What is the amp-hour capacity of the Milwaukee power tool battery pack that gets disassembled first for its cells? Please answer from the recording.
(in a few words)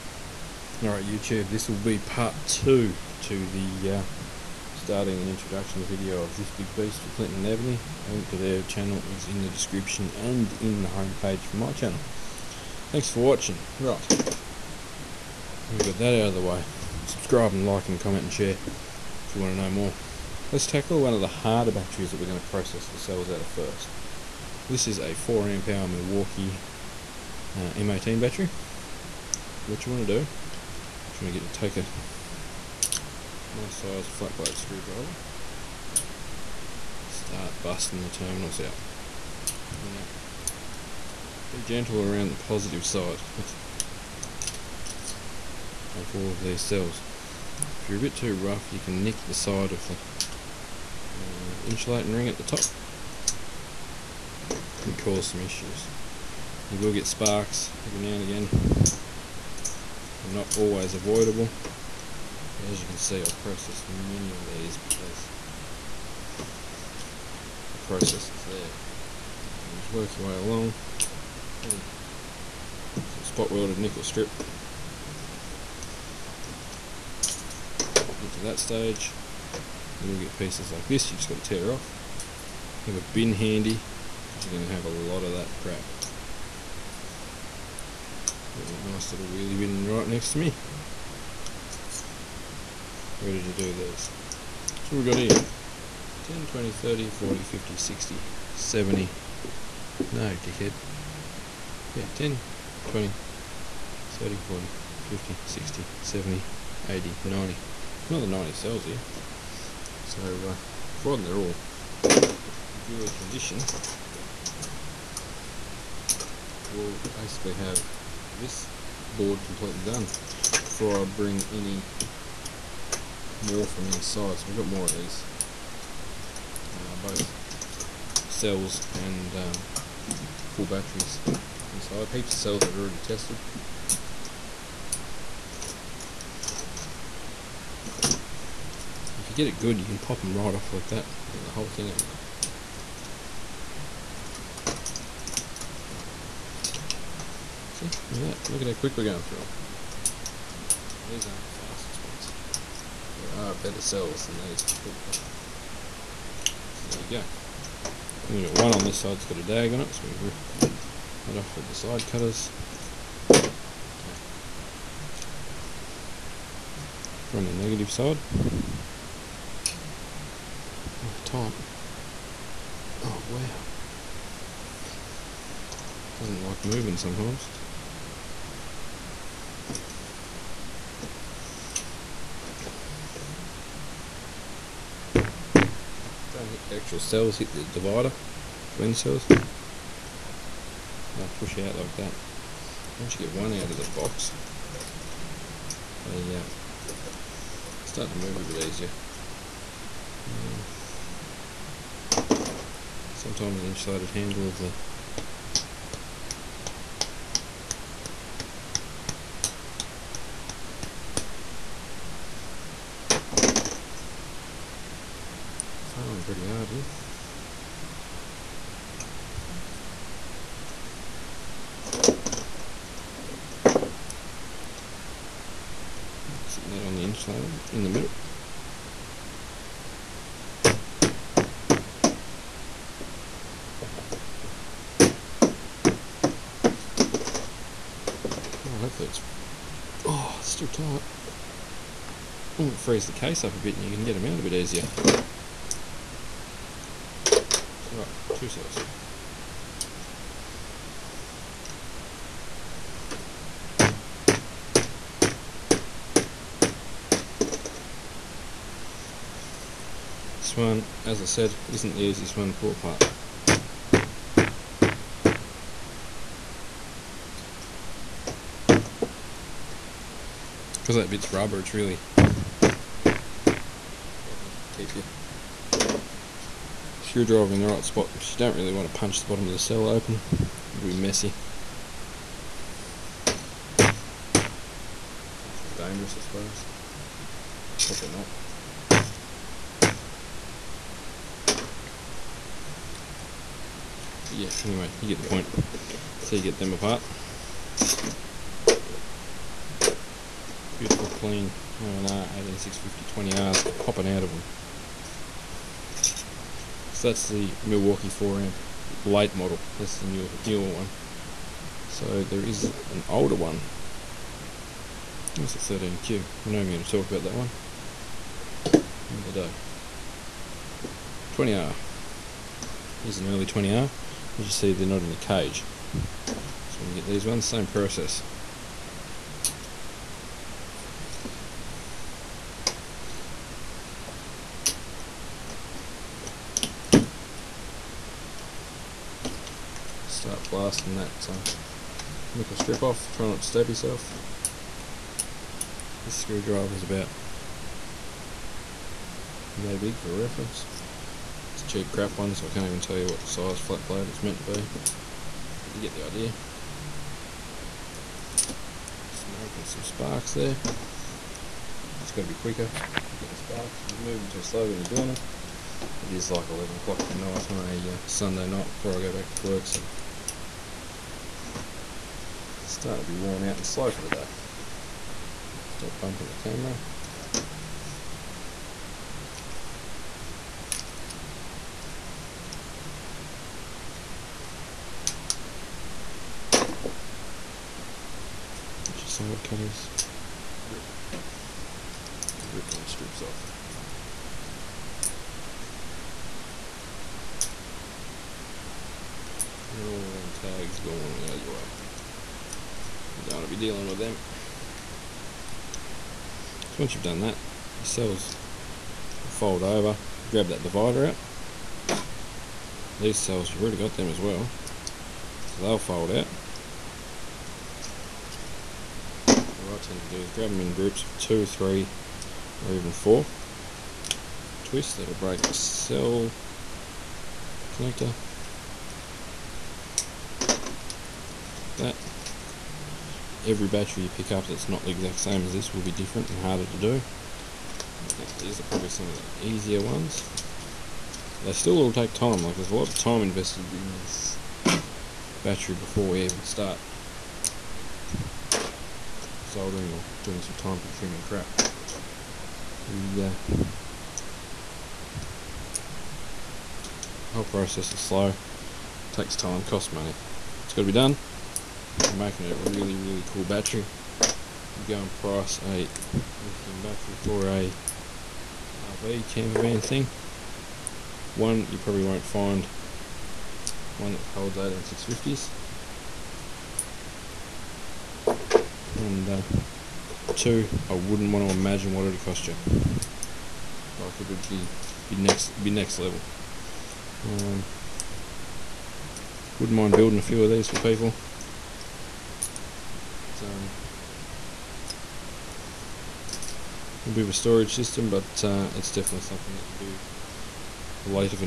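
4.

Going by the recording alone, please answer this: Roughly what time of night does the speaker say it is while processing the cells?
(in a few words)
11 o'clock.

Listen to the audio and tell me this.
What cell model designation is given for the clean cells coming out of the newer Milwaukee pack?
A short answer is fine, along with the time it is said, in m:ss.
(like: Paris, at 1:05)
INR 18650 20R, at 5:01.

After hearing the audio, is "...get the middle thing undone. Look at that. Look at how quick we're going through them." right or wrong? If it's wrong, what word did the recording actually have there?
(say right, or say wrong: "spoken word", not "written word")
wrong: "whole", not "middle".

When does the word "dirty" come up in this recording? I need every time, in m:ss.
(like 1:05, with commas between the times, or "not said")
not said.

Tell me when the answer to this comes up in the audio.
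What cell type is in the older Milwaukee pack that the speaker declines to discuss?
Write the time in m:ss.
5:15.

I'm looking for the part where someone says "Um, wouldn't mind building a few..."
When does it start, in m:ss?
8:07.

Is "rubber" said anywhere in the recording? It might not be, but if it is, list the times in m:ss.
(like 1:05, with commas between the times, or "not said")
4:31.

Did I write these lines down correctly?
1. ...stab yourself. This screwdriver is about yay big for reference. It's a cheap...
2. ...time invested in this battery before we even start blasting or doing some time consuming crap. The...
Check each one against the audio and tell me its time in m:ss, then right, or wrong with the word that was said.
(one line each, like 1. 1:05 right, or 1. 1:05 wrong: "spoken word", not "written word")
1. 5:43 right
2. 7:22 wrong: "soldering", not "blasting".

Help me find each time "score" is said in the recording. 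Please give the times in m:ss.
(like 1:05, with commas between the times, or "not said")
not said.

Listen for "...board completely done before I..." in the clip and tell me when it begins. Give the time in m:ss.
1:59.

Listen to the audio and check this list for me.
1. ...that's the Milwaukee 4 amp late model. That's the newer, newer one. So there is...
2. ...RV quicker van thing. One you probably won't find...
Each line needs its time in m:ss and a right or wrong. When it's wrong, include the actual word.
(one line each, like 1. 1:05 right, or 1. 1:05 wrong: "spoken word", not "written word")
1. 5:07 right
2. 7:48 wrong: "camper", not "quicker".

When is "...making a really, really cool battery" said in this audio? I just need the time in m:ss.
7:42.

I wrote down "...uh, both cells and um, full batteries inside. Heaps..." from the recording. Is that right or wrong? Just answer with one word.
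right.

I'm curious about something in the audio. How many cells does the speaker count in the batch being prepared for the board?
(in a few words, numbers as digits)
90.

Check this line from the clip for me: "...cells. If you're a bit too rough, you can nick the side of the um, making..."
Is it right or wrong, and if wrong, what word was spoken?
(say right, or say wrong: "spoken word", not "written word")
wrong: "insulating", not "making".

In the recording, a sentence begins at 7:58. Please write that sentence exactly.
And uh, two, I wouldn't want to imagine what it'd cost you.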